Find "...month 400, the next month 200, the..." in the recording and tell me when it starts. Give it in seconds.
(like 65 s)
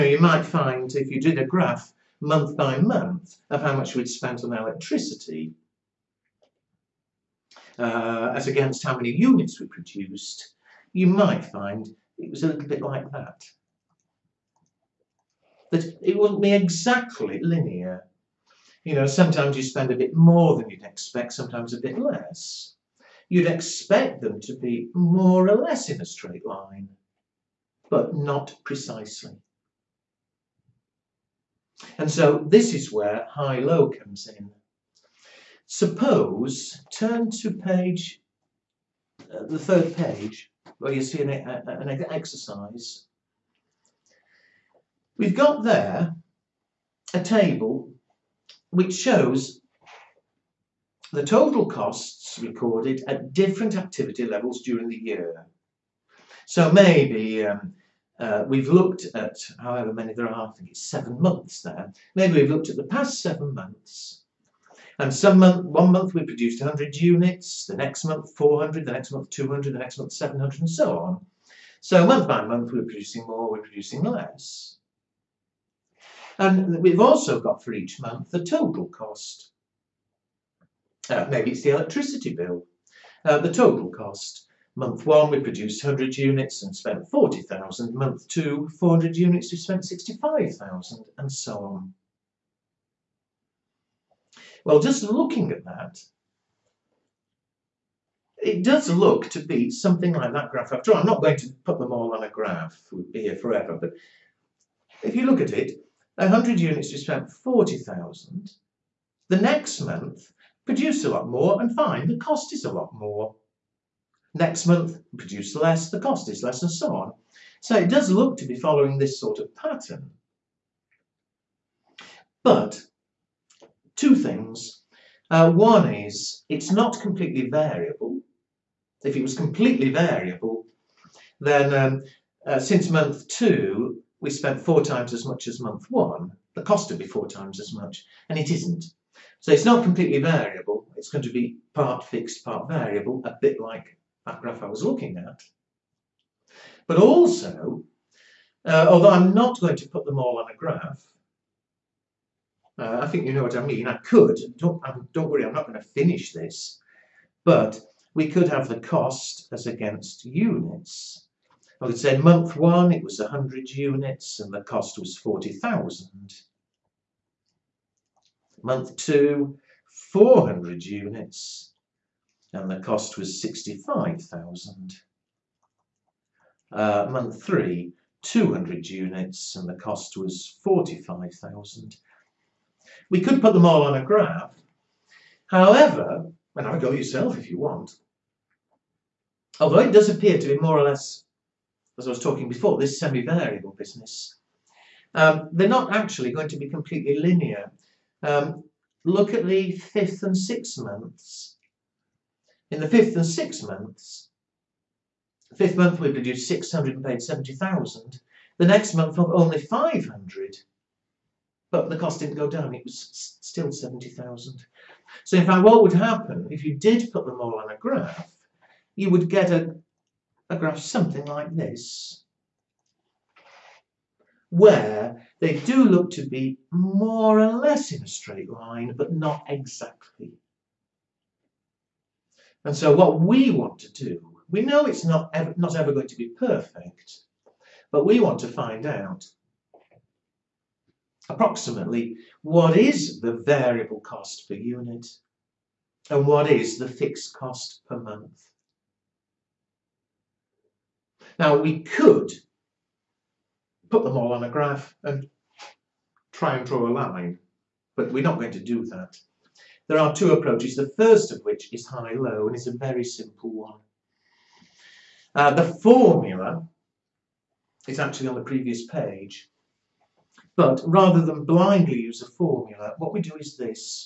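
68 s.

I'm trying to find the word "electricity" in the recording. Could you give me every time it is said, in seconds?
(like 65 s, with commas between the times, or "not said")
4 s, 81 s.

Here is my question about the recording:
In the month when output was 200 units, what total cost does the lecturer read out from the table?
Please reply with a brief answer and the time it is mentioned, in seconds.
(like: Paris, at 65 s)
45,000, at 179 s.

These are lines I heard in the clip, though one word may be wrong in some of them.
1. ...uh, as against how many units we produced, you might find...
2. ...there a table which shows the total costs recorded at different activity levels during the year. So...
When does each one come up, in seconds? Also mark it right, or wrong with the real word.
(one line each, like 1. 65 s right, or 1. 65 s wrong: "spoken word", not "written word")
1. 7 s right
2. 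45 s right.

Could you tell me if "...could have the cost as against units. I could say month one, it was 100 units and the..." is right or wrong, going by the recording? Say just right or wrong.
right.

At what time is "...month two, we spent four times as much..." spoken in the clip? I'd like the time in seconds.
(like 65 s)
132 s.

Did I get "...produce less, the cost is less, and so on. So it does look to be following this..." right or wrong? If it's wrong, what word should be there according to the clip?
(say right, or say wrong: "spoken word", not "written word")
right.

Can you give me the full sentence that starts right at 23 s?
You'd expect them to be more or less in a straight line, but not precisely.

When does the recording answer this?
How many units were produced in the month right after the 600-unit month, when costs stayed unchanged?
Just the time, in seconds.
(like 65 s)
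208 s.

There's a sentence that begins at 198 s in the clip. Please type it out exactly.
Um, look at the fifth and sixth months.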